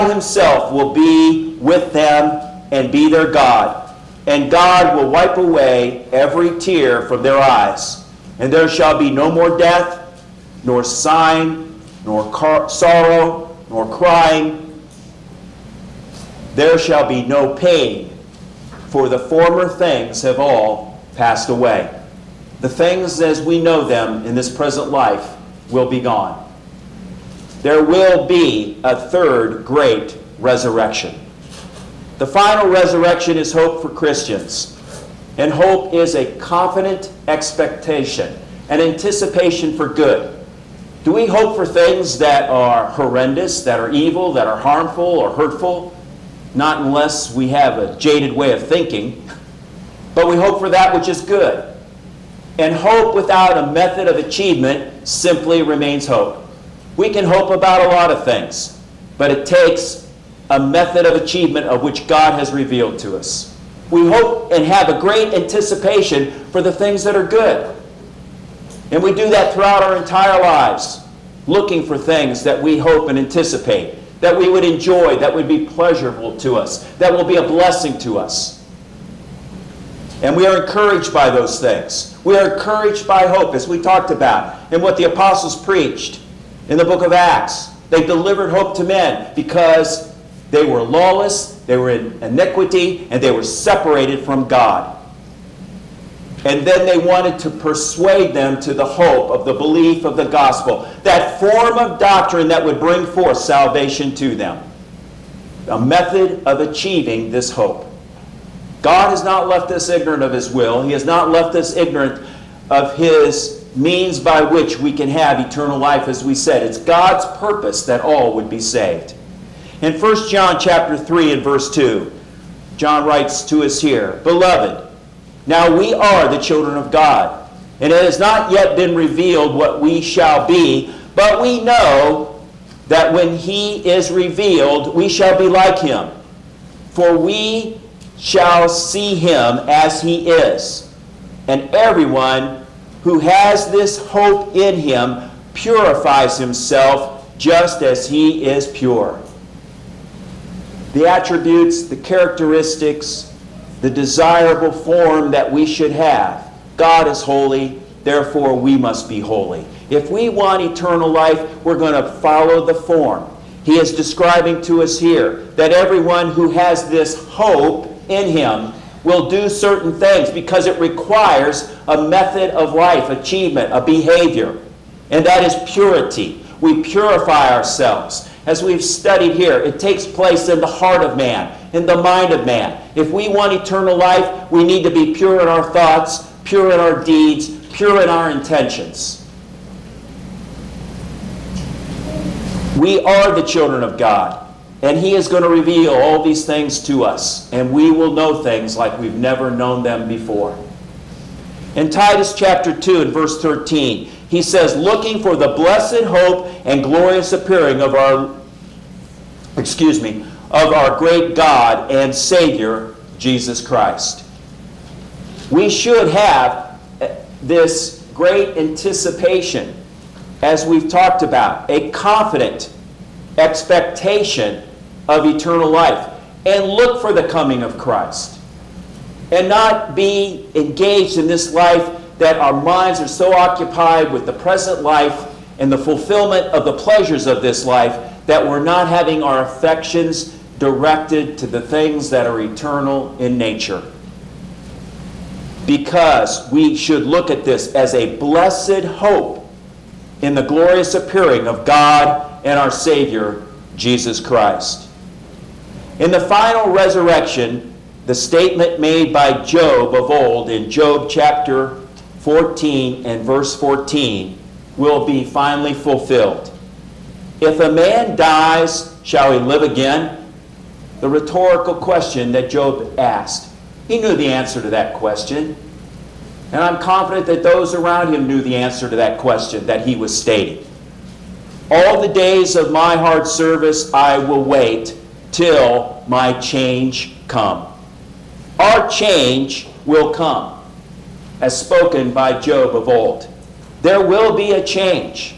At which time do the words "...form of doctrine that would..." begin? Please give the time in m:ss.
1:41.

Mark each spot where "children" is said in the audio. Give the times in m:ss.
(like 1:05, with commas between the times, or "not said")
2:06, 3:13.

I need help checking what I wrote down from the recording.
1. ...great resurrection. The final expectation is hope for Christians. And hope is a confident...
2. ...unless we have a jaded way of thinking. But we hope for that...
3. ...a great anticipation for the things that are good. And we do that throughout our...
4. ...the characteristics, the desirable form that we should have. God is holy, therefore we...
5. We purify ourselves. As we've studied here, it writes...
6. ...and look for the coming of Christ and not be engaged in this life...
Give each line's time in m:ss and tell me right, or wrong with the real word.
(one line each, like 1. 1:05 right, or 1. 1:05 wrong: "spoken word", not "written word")
1. 0:29 wrong: "resurrection", not "expectation"
2. 0:46 right
3. 1:04 right
4. 2:31 right
5. 2:56 wrong: "takes", not "writes"
6. 3:46 right.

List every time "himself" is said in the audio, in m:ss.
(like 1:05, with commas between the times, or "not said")
0:00, 2:26.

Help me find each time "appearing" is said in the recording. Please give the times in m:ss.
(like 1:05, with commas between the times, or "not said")
3:27, 4:10.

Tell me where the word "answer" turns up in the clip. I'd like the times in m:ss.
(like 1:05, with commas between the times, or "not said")
4:34, 4:38.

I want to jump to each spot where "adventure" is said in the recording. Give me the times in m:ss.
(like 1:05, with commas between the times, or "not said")
not said.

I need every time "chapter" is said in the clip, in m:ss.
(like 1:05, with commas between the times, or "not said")
2:00, 3:22, 4:21.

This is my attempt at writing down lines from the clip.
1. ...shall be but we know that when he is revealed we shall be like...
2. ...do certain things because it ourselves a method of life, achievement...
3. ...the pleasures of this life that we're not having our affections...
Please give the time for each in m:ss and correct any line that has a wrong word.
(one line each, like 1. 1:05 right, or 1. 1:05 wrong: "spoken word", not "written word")
1. 2:10 right
2. 2:49 wrong: "requires", not "ourselves"
3. 3:56 right.